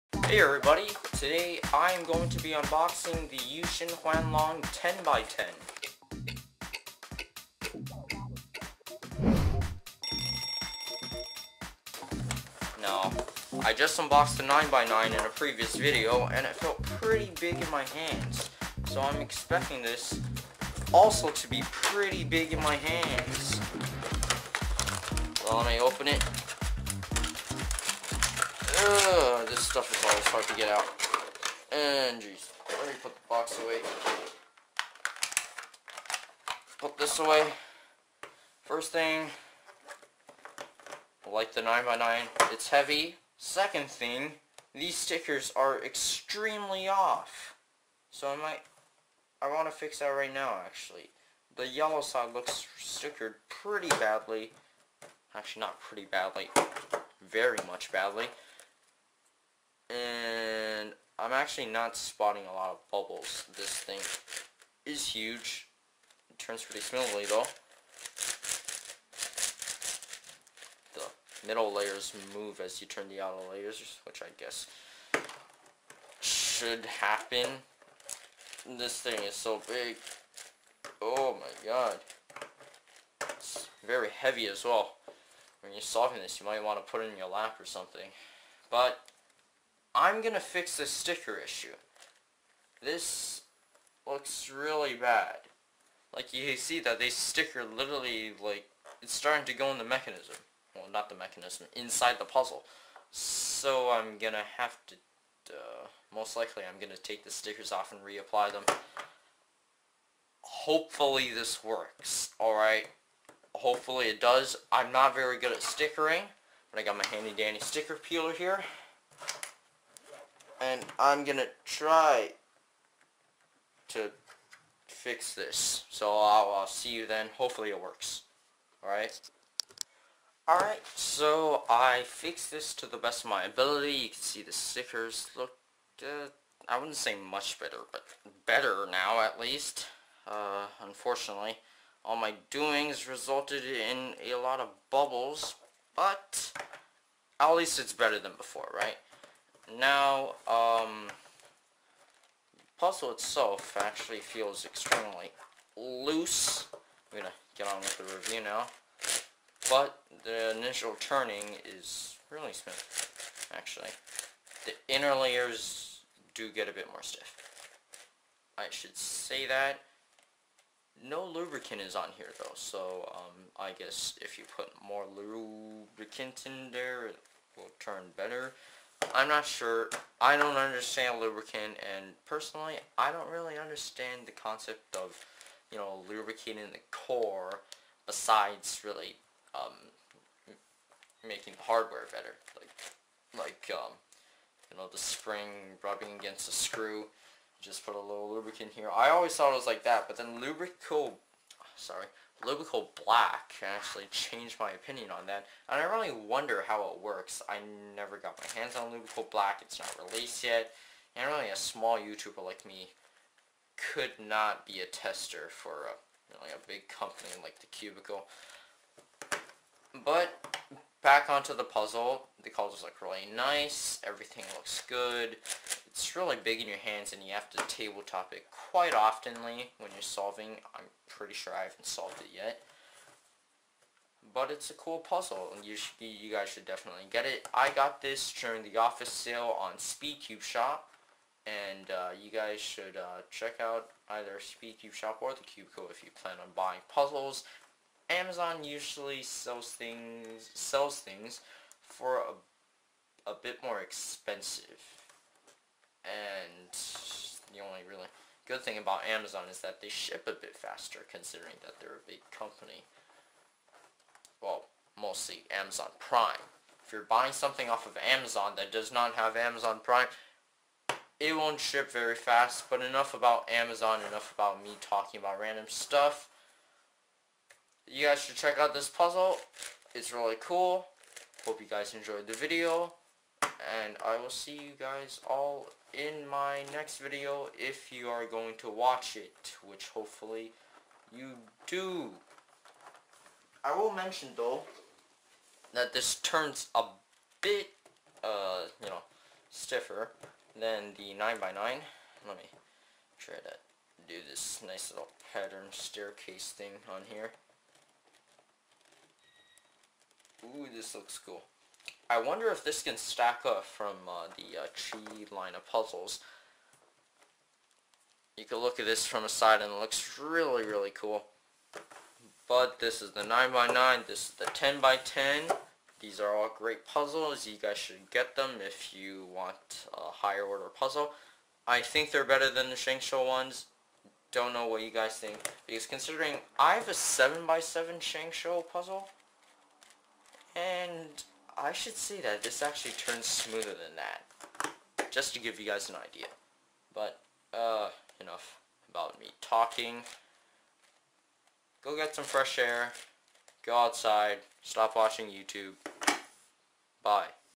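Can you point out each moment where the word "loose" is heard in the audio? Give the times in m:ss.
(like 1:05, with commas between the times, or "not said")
2:35.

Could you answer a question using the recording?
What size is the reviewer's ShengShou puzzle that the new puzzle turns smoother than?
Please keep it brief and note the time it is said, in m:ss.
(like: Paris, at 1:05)
7x7, at 5:36.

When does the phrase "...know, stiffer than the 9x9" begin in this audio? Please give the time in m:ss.
4:58.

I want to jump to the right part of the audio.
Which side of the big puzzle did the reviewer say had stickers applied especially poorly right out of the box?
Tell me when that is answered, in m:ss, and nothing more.
0:51.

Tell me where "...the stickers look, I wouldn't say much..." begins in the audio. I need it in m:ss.
2:14.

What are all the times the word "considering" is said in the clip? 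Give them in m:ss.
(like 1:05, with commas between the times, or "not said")
4:21, 5:35.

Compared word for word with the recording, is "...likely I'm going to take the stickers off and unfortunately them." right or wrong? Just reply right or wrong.
wrong.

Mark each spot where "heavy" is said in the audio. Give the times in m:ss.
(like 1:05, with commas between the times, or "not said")
0:42, 1:24.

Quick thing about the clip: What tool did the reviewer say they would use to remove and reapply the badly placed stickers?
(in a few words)
Sticker peeler.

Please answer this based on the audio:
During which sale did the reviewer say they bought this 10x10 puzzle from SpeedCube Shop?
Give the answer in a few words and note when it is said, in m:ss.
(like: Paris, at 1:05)
Office sale, at 3:58.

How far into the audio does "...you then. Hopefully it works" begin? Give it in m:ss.
2:06.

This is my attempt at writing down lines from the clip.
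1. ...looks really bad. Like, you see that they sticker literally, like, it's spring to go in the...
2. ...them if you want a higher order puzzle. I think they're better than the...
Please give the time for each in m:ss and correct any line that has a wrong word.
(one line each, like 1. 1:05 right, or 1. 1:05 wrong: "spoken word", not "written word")
1. 1:34 wrong: "starting", not "spring"
2. 5:28 right.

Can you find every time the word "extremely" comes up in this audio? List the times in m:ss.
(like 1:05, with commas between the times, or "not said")
0:45, 2:34.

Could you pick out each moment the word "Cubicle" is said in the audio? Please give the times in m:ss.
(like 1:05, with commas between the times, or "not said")
3:37, 4:05.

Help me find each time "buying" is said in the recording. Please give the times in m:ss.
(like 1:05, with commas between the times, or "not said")
4:06, 4:27.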